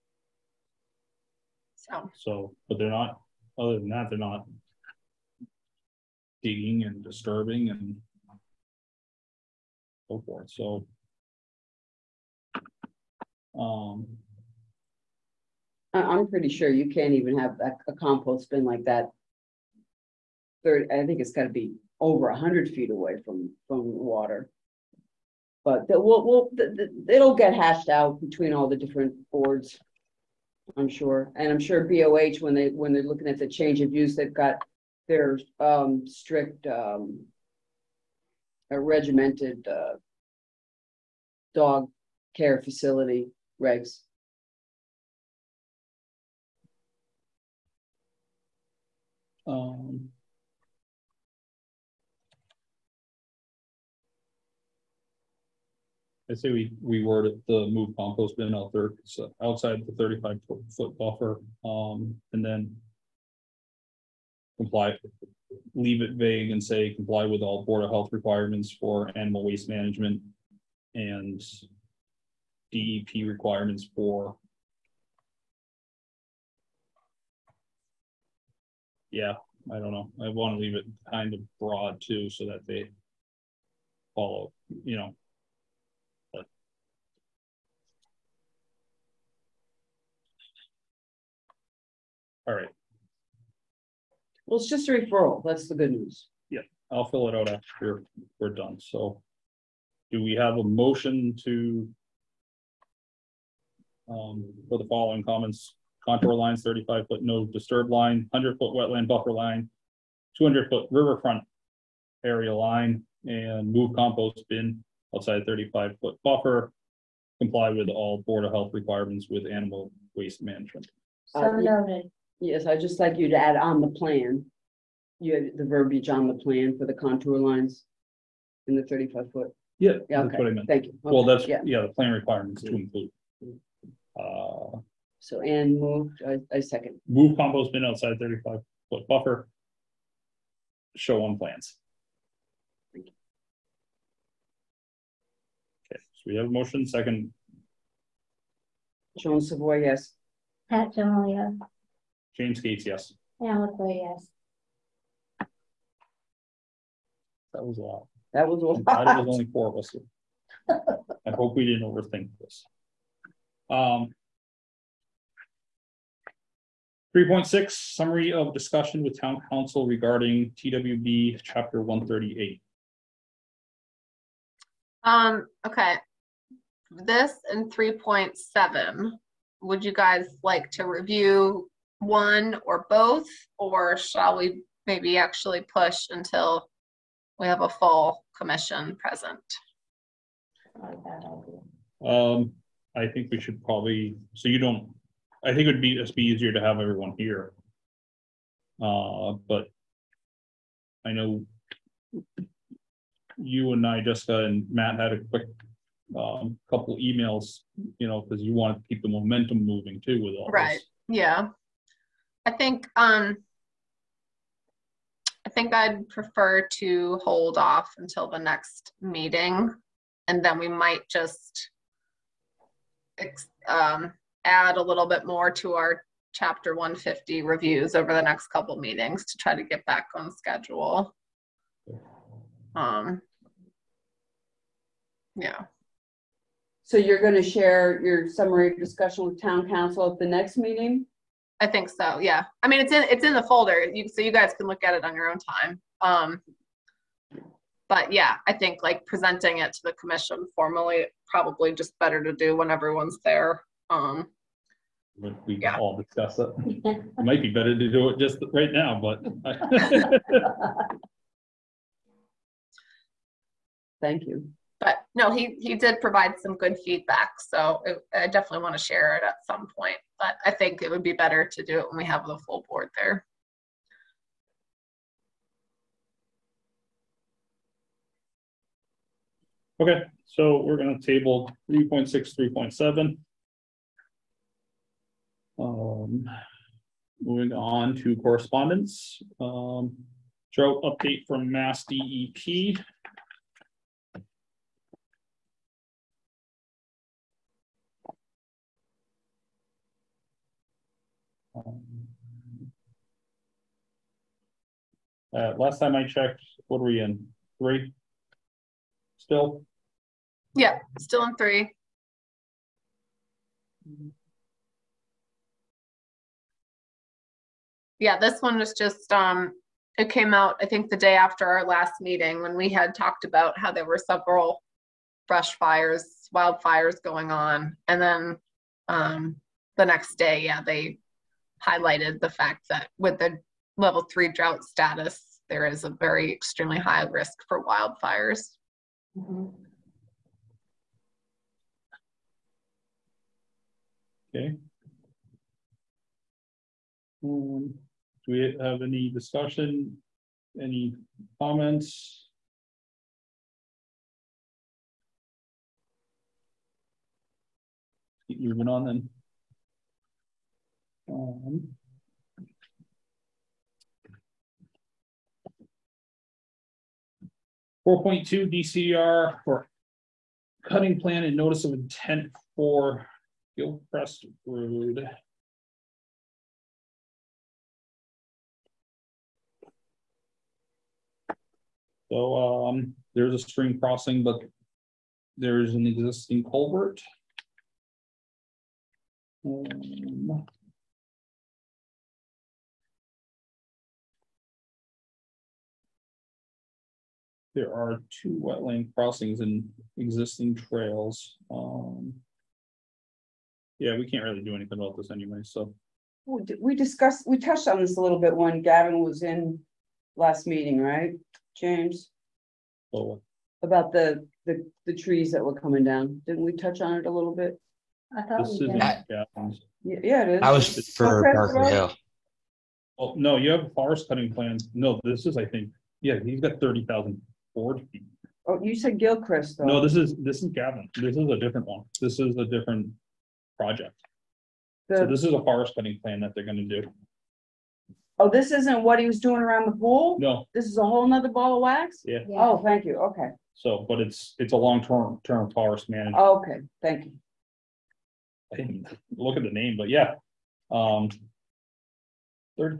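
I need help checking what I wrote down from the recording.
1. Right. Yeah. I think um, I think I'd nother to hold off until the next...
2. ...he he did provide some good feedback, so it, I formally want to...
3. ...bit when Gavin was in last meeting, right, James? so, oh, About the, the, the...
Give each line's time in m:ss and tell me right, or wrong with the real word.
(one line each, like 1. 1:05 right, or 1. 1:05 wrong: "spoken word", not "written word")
1. 3:31 wrong: "prefer", not "nother"
2. 4:25 wrong: "definitely", not "formally"
3. 6:48 right.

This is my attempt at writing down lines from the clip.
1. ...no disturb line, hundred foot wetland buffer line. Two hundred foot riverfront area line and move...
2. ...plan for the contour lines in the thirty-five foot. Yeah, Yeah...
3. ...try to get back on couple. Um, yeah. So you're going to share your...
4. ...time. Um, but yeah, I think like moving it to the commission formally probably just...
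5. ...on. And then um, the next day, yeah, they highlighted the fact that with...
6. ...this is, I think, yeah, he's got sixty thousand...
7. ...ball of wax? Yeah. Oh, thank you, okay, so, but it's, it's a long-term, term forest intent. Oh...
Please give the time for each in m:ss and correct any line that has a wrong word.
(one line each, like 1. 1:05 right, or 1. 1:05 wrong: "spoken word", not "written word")
1. 1:47 right
2. 2:06 right
3. 3:49 wrong: "schedule", not "couple"
4. 4:05 wrong: "presenting", not "moving"
5. 5:27 right
6. 7:05 wrong: "thirty", not "sixty"
7. 7:21 wrong: "management", not "intent".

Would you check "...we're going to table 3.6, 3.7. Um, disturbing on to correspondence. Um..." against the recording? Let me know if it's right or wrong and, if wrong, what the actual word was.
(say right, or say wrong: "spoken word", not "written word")
wrong: "moving", not "disturbing".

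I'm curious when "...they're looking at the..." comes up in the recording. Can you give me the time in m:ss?
0:32.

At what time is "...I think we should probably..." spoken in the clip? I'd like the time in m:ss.
3:12.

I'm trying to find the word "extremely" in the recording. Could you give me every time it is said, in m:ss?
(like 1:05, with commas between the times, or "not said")
5:36.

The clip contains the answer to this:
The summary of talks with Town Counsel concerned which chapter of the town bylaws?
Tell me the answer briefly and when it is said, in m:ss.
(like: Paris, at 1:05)
Chapter 138, at 2:51.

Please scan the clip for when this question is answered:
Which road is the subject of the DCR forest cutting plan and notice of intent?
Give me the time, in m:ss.
6:13.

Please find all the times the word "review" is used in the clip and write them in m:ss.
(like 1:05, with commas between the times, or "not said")
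3:00, 3:47.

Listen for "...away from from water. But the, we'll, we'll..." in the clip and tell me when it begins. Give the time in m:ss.
0:22.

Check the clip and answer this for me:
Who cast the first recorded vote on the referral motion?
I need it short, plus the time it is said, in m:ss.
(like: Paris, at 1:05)
Joan Savoy, at 2:29.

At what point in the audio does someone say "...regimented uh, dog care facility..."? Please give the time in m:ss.
0:38.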